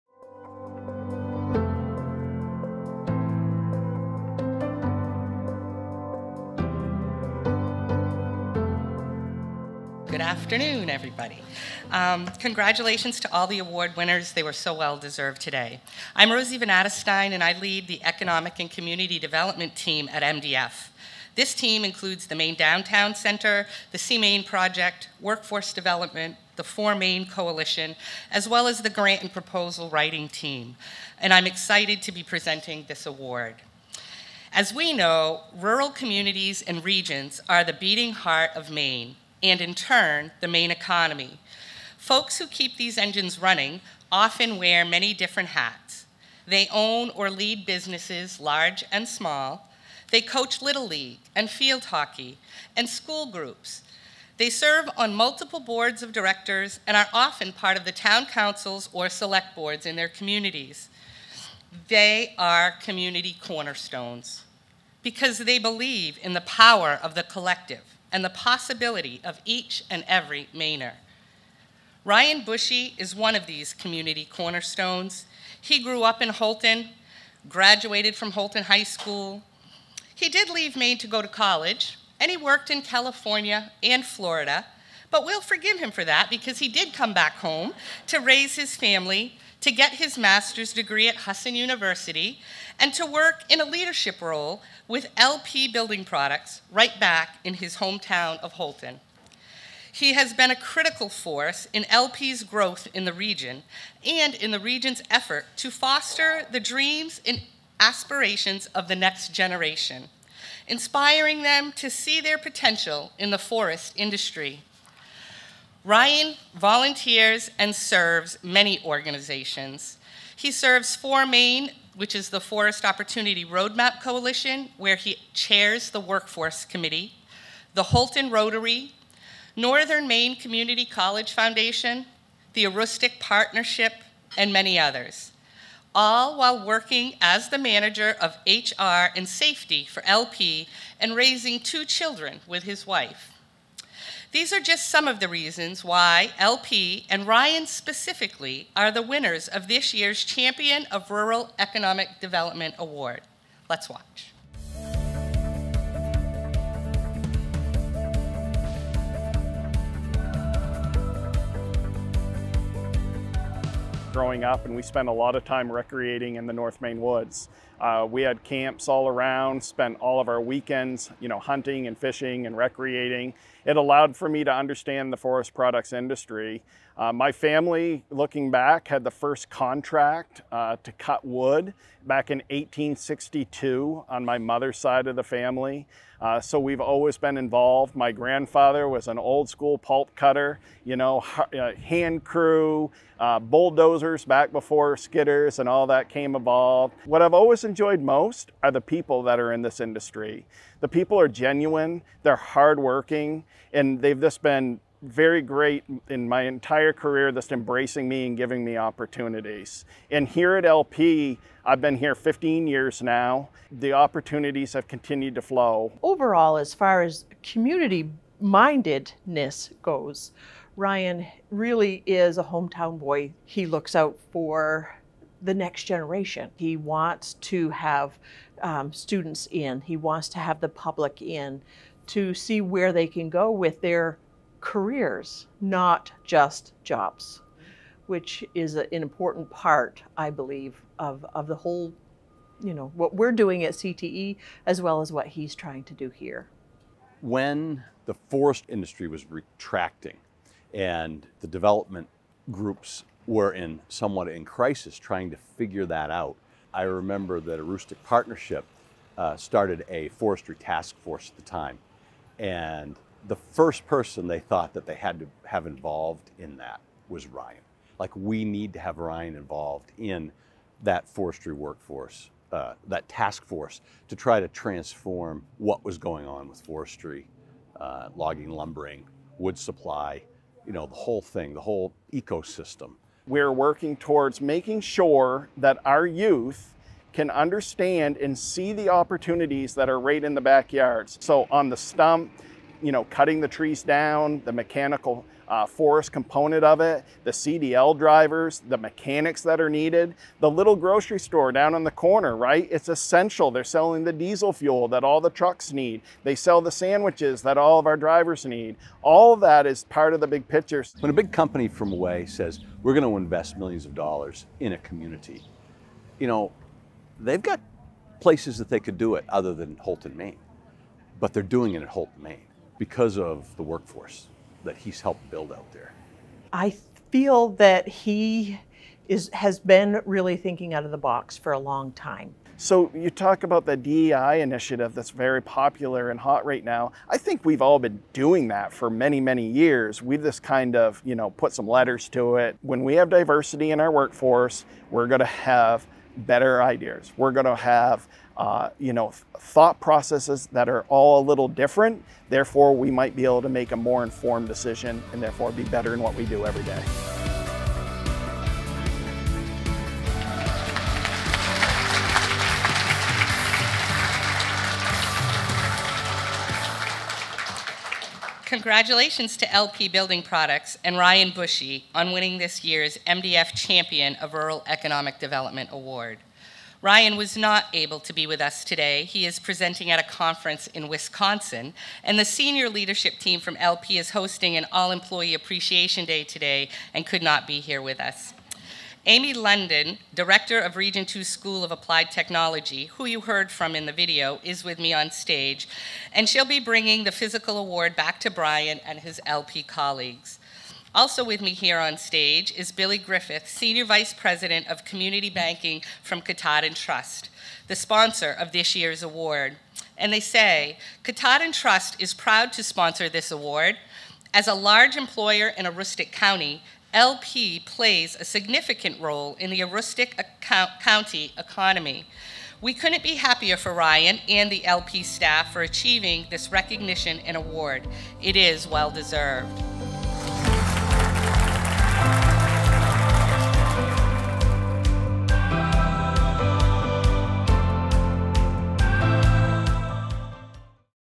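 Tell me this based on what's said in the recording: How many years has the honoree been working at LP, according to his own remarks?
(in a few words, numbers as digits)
15 years.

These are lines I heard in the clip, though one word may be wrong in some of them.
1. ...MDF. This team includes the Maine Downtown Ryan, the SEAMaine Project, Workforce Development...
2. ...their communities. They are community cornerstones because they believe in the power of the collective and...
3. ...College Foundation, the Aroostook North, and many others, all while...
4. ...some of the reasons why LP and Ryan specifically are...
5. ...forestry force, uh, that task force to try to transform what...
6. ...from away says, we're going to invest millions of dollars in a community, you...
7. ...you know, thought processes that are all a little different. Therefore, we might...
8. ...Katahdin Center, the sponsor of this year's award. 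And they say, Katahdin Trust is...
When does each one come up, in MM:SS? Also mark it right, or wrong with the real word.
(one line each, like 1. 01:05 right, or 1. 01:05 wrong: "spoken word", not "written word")
1. 00:20 wrong: "Center", not "Ryan"
2. 00:59 right
3. 02:10 wrong: "Partnership", not "North"
4. 02:24 right
5. 04:31 wrong: "workforce", not "force"
6. 05:11 right
7. 05:48 right
8. 06:46 wrong: "Trust", not "Center".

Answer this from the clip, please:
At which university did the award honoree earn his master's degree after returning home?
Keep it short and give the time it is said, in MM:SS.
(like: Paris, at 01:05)
Husson University, at 01:31.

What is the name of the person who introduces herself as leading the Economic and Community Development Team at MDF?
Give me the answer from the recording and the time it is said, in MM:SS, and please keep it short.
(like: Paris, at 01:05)
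Rosie Vanadestine, at 00:16.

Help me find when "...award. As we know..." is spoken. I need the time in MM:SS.
00:33.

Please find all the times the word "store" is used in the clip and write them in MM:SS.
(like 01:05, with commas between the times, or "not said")
05:01.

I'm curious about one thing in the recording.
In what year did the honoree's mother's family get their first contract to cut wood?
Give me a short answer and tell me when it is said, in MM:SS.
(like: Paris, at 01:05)
1862, at 03:02.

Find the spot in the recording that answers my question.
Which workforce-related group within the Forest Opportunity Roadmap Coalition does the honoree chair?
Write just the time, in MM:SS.
02:05.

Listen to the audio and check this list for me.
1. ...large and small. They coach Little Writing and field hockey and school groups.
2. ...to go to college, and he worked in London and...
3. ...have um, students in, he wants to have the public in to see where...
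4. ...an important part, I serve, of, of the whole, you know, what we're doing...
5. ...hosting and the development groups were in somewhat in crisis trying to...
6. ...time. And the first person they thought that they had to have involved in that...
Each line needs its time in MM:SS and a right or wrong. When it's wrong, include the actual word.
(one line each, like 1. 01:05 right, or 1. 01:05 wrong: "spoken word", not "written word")
1. 00:48 wrong: "League", not "Writing"
2. 01:20 wrong: "California", not "London"
3. 03:47 right
4. 03:58 wrong: "believe", not "serve"
5. 04:09 wrong: "retracting", not "hosting"
6. 04:21 right.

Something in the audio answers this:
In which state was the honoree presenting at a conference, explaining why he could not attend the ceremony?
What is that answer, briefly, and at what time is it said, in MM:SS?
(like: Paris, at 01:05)
Wisconsin, at 06:20.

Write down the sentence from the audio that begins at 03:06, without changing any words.
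Uh, so we've always been involved.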